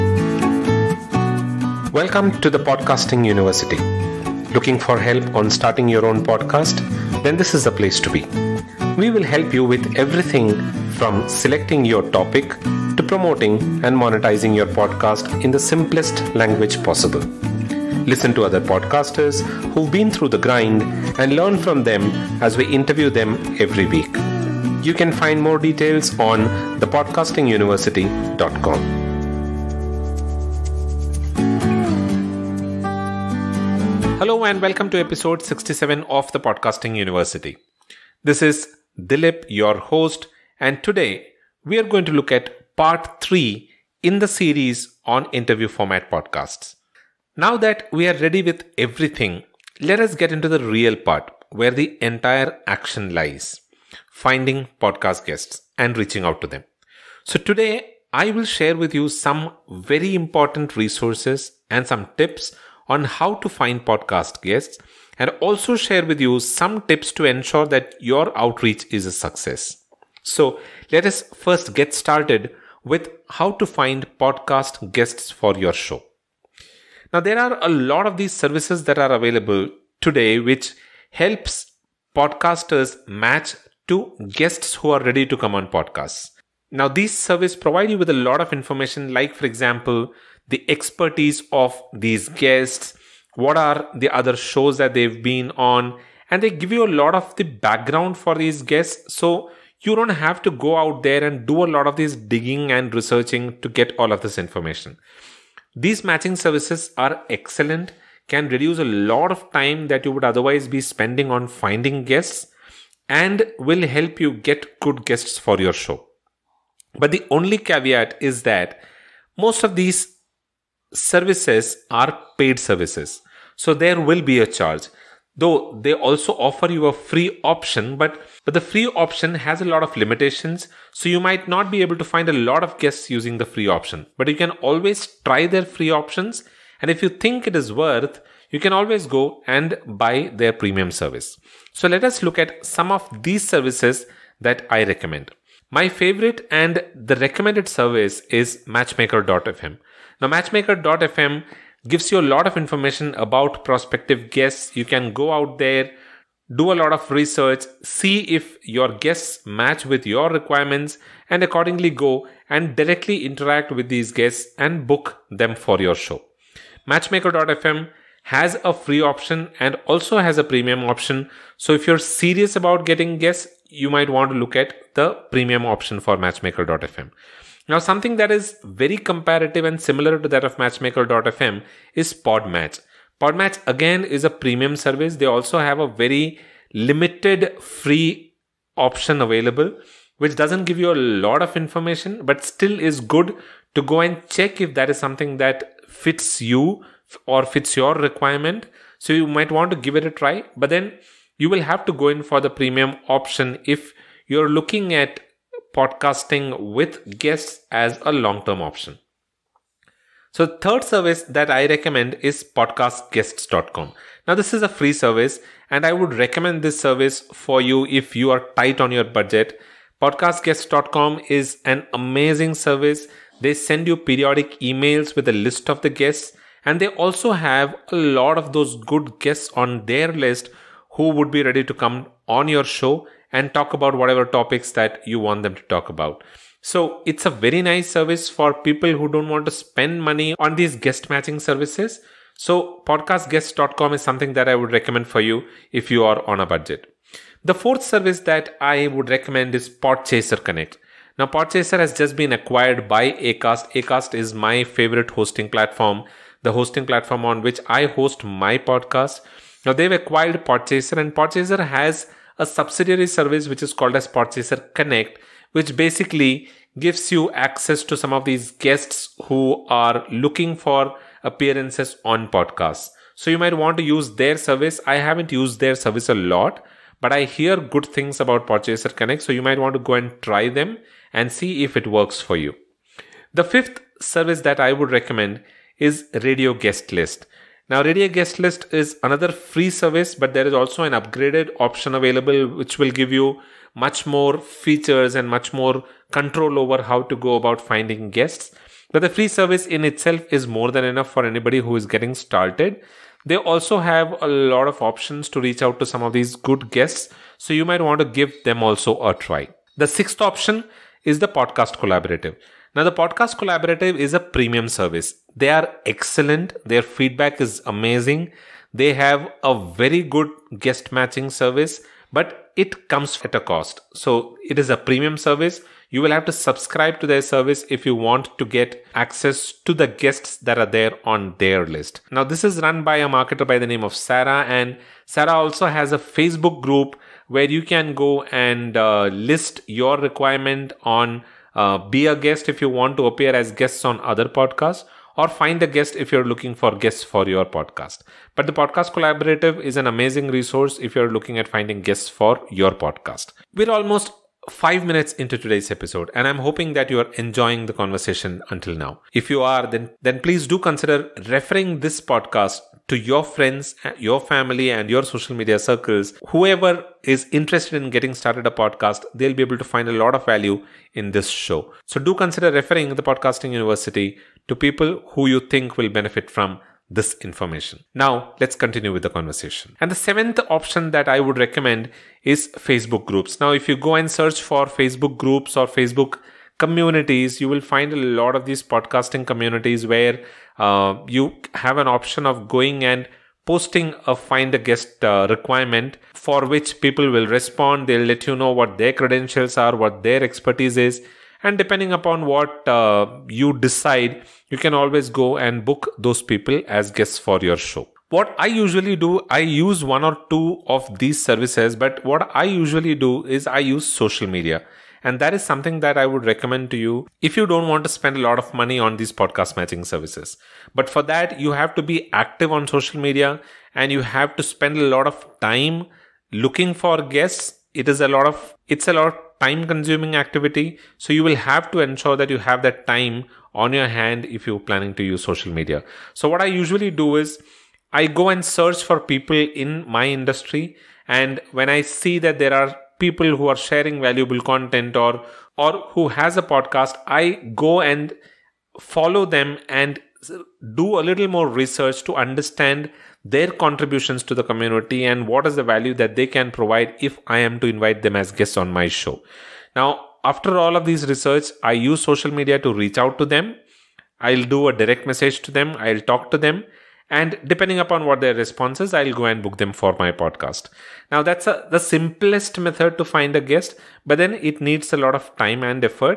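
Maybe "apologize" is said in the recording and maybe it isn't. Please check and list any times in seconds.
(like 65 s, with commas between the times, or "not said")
not said.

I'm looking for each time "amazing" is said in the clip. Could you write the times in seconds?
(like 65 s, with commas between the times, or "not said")
221 s, 317 s, 349 s.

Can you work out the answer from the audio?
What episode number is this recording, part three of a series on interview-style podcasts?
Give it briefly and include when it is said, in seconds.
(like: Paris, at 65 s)
67, at 34 s.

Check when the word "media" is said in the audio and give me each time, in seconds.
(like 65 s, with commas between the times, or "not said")
365 s, 414 s, 422 s, 435 s, 462 s.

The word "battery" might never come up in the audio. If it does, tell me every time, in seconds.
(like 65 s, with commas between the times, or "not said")
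not said.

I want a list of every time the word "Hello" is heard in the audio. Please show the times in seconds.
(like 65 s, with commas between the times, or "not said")
34 s.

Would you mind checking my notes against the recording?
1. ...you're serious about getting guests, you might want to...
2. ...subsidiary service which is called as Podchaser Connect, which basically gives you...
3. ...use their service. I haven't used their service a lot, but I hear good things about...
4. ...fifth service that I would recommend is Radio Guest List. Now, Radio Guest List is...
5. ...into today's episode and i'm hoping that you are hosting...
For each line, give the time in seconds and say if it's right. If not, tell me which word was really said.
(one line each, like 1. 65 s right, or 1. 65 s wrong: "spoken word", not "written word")
1. 171 s right
2. 262 s right
3. 273 s right
4. 283 s right
5. 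355 s wrong: "enjoying", not "hosting".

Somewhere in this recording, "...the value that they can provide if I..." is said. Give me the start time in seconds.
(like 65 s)
455 s.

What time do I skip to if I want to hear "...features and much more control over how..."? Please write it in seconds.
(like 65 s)
294 s.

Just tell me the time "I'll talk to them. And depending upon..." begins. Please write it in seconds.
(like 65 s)
465 s.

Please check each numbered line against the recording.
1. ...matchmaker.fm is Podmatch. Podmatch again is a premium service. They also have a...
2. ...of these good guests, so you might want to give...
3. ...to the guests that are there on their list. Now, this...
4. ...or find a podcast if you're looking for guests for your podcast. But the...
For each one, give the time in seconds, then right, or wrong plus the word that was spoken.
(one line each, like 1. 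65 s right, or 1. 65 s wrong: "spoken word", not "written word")
1. 180 s right
2. 306 s right
3. 329 s right
4. 345 s wrong: "guest", not "podcast".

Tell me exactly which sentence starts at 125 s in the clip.
Though they also offer you a free option, but, but the free option has a lot of limitations.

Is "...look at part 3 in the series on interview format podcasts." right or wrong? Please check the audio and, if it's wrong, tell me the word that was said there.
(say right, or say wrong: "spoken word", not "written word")
right.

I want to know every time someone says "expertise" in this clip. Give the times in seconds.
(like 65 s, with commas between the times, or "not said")
90 s, 400 s.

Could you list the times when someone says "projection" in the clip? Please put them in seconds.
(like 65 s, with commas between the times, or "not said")
not said.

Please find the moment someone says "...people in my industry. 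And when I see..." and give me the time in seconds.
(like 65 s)
438 s.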